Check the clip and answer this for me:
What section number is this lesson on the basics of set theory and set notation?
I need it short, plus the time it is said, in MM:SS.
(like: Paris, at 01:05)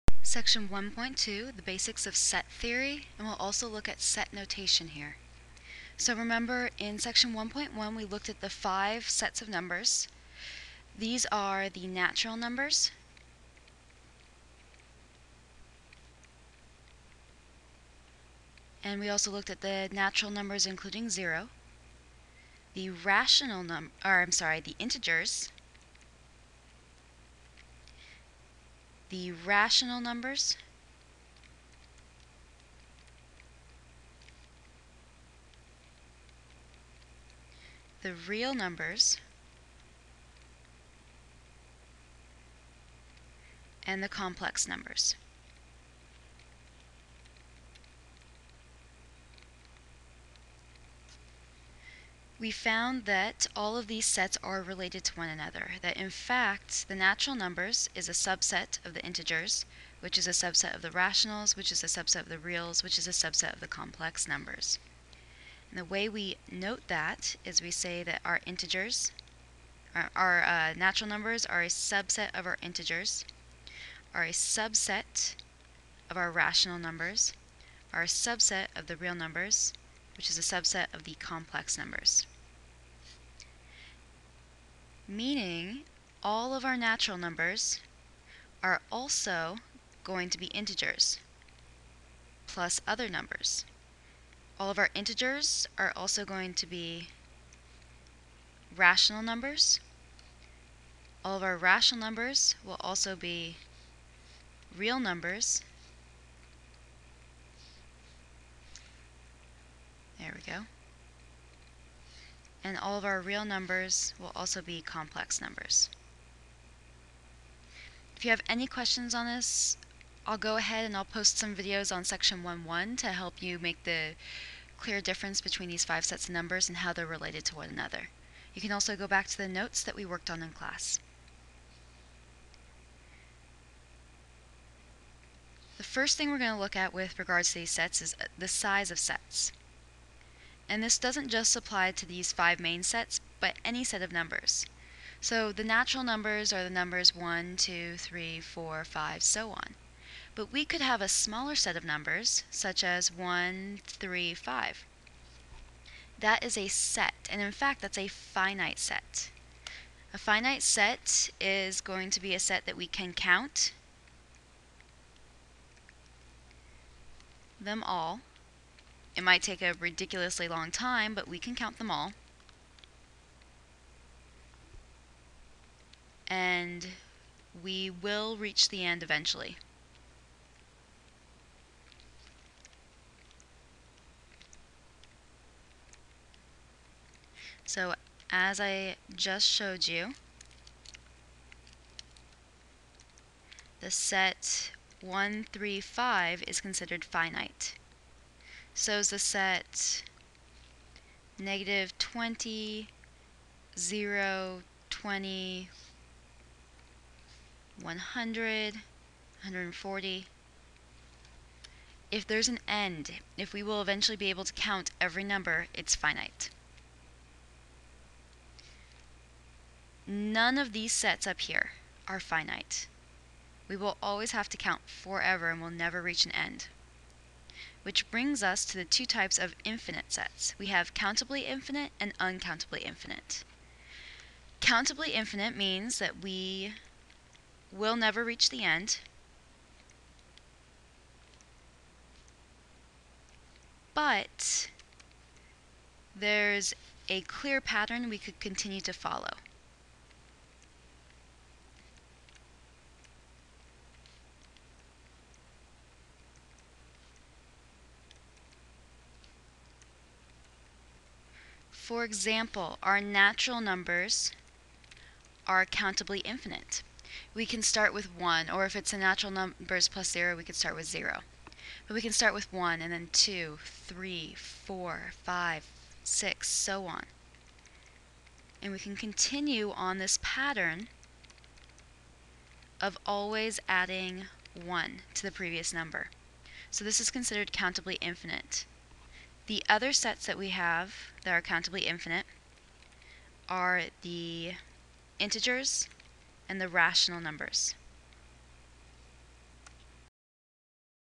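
1.2, at 00:00.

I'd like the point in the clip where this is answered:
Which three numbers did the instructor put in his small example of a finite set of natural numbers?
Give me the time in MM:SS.
02:33.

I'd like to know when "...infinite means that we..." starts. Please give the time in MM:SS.
03:55.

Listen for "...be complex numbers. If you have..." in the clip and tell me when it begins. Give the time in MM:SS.
01:54.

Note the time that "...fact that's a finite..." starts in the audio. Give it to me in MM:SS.
02:37.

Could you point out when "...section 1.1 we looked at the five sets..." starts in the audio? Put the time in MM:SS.
00:06.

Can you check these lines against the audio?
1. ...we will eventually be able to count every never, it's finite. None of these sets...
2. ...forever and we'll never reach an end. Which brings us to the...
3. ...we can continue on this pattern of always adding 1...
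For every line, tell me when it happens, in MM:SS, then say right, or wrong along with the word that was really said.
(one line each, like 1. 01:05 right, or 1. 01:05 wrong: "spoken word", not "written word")
1. 03:33 wrong: "number", not "never"
2. 03:44 right
3. 04:38 right.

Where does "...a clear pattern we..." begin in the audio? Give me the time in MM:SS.
04:07.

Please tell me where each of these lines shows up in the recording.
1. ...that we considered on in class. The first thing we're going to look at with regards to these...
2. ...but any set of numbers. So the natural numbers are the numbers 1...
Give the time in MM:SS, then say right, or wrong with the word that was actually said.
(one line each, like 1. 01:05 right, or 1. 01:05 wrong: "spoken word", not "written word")
1. 02:09 wrong: "worked", not "considered"
2. 02:23 right.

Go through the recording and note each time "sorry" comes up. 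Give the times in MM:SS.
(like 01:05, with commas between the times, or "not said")
00:24.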